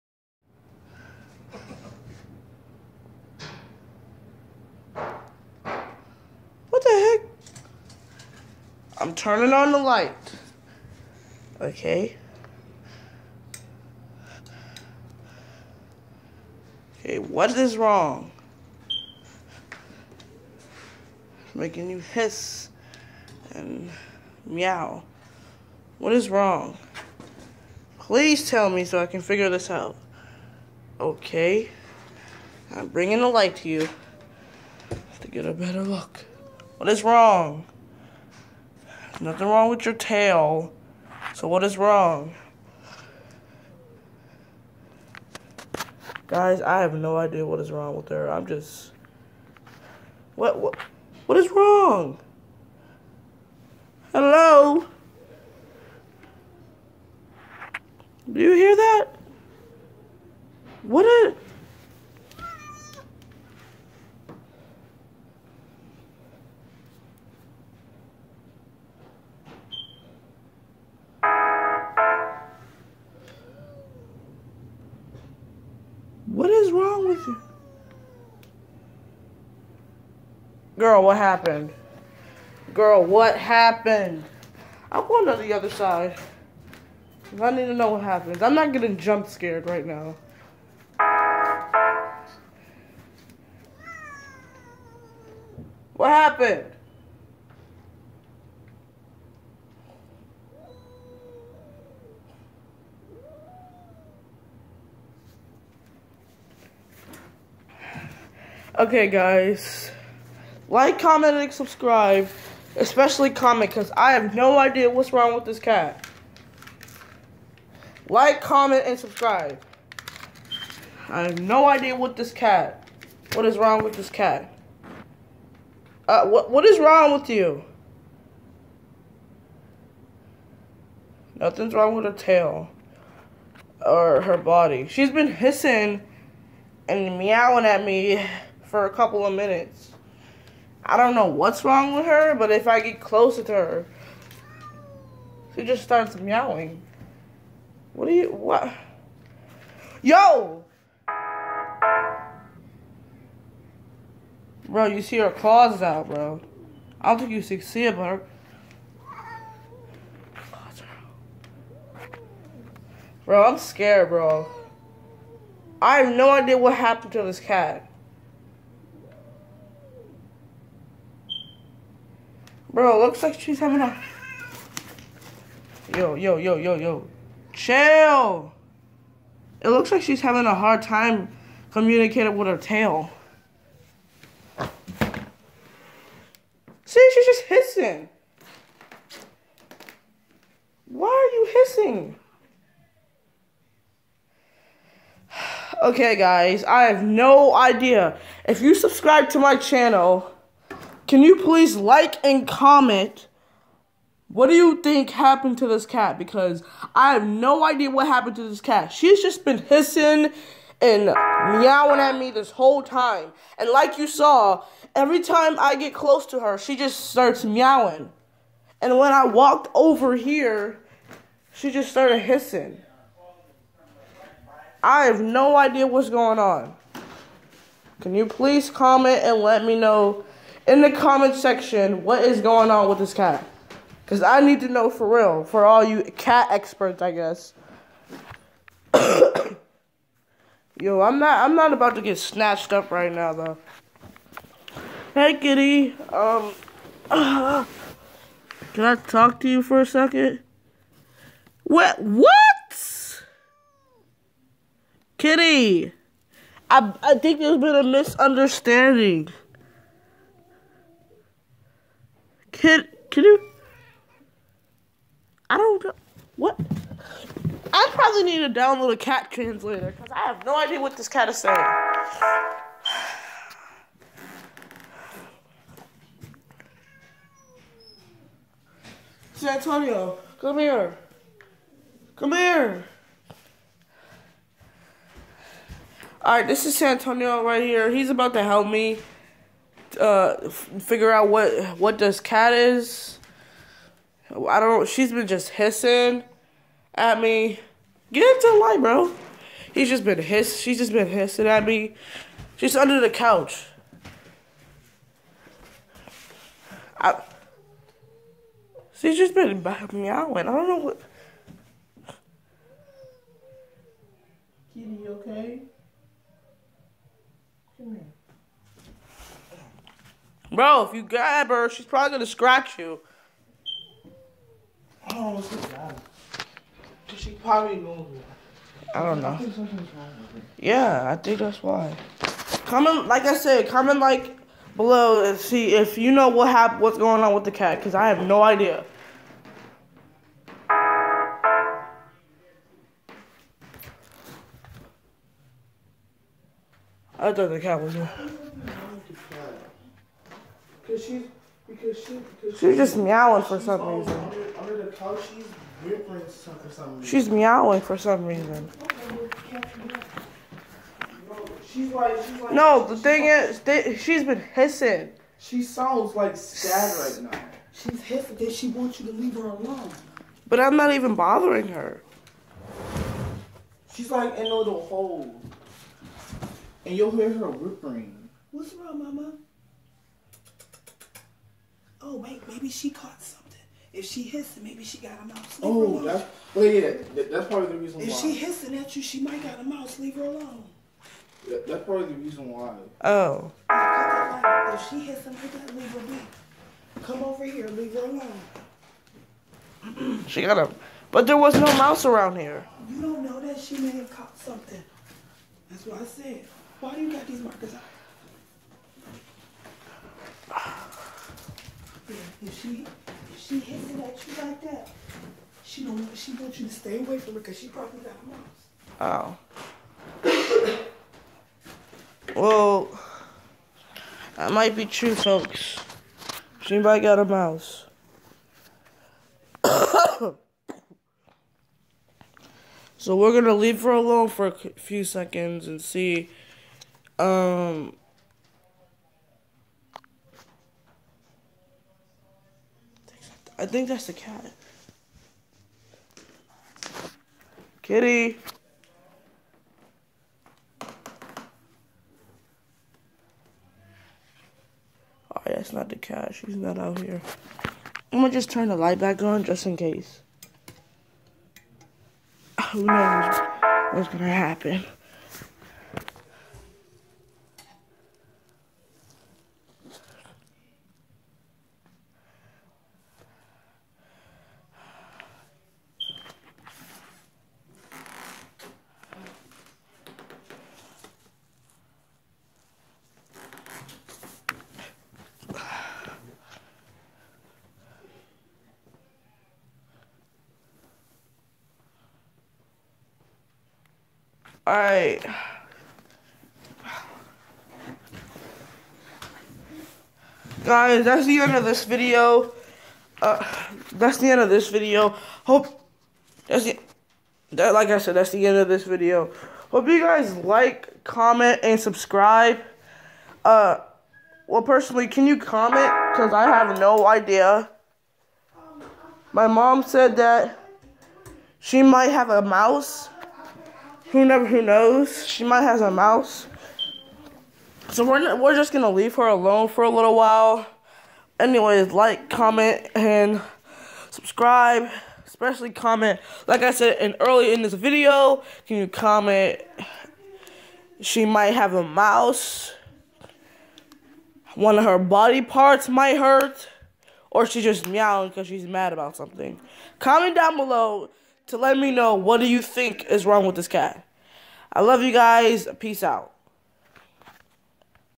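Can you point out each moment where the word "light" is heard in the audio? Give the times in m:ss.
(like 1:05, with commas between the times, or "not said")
0:09, 0:33, 4:58, 7:38.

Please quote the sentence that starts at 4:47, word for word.
He's about to help me uh figure out what what does cat is.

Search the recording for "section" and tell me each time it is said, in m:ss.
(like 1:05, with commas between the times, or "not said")
3:51.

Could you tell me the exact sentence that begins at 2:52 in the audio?
Bro, looks like she's having a...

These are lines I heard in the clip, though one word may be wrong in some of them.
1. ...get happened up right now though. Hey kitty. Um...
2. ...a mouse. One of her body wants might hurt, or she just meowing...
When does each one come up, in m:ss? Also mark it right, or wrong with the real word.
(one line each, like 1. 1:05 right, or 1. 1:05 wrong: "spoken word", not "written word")
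1. 4:02 wrong: "snatched", not "happened"
2. 9:01 wrong: "parts", not "wants".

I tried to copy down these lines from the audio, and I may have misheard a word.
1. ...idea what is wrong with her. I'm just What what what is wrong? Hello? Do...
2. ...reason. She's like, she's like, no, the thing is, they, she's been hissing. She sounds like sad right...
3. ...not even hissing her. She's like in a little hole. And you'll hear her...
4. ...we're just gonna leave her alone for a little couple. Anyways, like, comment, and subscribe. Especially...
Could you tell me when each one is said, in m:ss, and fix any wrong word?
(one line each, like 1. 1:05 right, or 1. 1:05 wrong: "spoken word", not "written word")
1. 0:47 right
2. 5:58 right
3. 6:10 wrong: "bothering", not "hissing"
4. 8:48 wrong: "while", not "couple".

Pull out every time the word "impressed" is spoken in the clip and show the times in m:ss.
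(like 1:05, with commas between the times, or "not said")
not said.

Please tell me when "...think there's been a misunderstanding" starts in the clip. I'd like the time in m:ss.
4:17.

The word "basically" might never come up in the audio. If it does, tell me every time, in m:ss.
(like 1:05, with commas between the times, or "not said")
not said.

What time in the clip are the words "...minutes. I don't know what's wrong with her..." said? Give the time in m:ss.
2:19.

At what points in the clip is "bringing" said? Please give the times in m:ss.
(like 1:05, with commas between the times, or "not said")
0:32.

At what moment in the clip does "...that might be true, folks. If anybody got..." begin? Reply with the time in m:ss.
7:04.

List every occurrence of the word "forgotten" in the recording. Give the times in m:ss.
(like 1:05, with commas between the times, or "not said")
not said.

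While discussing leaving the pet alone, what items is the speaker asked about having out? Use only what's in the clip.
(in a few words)
markers.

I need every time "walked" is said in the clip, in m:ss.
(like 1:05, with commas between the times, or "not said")
3:39.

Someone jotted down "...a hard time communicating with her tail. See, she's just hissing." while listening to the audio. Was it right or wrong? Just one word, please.
right.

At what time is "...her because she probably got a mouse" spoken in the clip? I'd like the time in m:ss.
6:57.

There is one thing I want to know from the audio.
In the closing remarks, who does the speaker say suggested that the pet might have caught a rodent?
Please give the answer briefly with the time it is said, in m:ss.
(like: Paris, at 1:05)
My mom, at 8:39.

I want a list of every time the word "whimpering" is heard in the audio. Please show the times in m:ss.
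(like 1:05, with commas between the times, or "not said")
5:55, 6:17.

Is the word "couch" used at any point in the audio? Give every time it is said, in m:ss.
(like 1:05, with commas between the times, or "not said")
5:03, 5:54.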